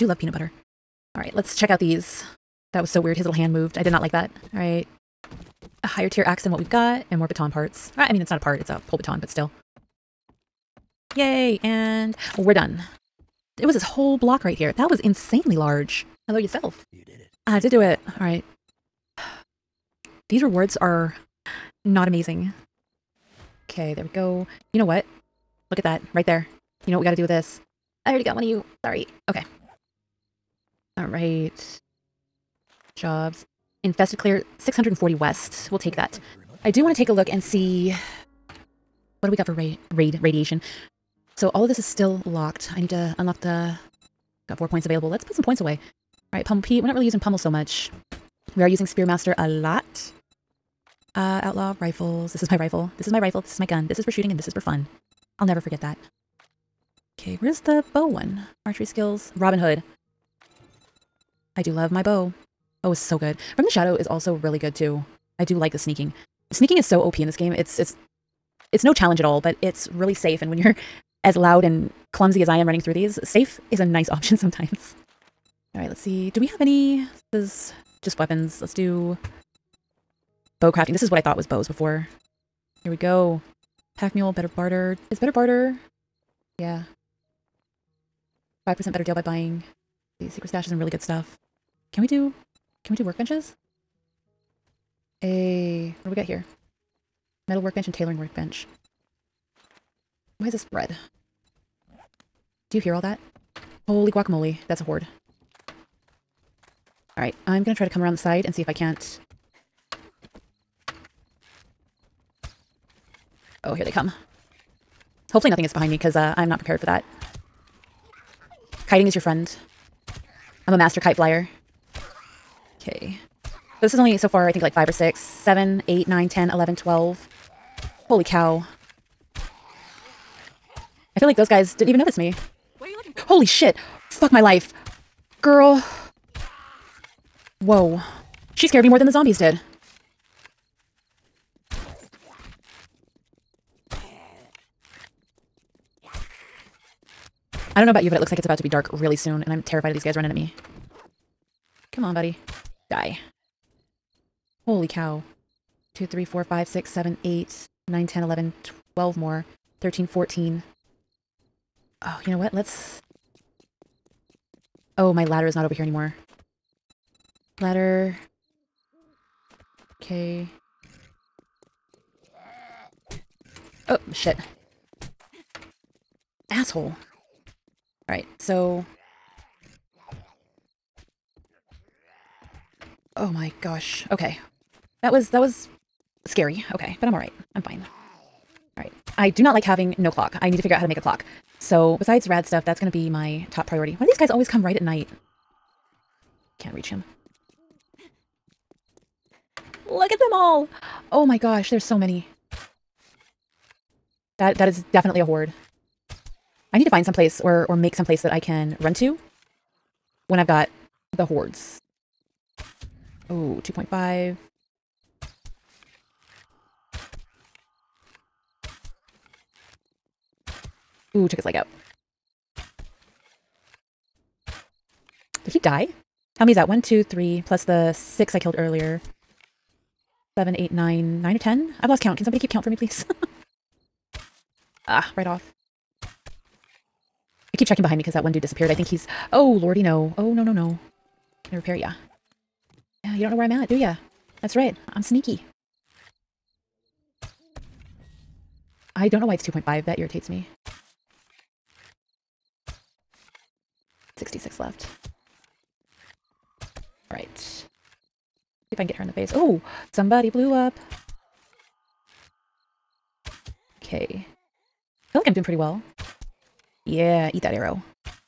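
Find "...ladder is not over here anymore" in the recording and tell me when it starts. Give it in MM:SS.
02:45.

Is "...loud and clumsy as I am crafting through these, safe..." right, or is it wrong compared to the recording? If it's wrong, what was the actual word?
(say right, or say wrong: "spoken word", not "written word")
wrong: "running", not "crafting".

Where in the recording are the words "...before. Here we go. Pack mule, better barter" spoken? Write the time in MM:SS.
01:21.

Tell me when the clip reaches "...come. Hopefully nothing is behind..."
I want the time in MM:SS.
01:53.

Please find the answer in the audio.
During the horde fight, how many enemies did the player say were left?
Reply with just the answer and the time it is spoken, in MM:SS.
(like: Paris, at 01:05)
66, at 04:14.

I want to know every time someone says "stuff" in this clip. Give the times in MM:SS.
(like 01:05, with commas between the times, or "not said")
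01:31, 03:12.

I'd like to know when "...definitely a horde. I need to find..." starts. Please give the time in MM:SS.
03:24.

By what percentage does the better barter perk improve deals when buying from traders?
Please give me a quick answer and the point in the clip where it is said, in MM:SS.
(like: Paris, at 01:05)
5%, at 01:28.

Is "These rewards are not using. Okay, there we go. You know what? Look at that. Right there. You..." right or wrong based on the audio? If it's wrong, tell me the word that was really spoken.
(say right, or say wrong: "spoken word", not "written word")
wrong: "amazing", not "using".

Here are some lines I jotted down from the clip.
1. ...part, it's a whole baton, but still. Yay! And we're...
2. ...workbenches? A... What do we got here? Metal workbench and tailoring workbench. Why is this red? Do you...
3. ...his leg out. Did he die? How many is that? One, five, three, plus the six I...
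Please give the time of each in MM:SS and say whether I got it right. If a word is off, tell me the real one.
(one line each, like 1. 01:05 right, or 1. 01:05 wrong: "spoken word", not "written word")
1. 00:08 right
2. 01:33 right
3. 03:41 wrong: "two", not "five".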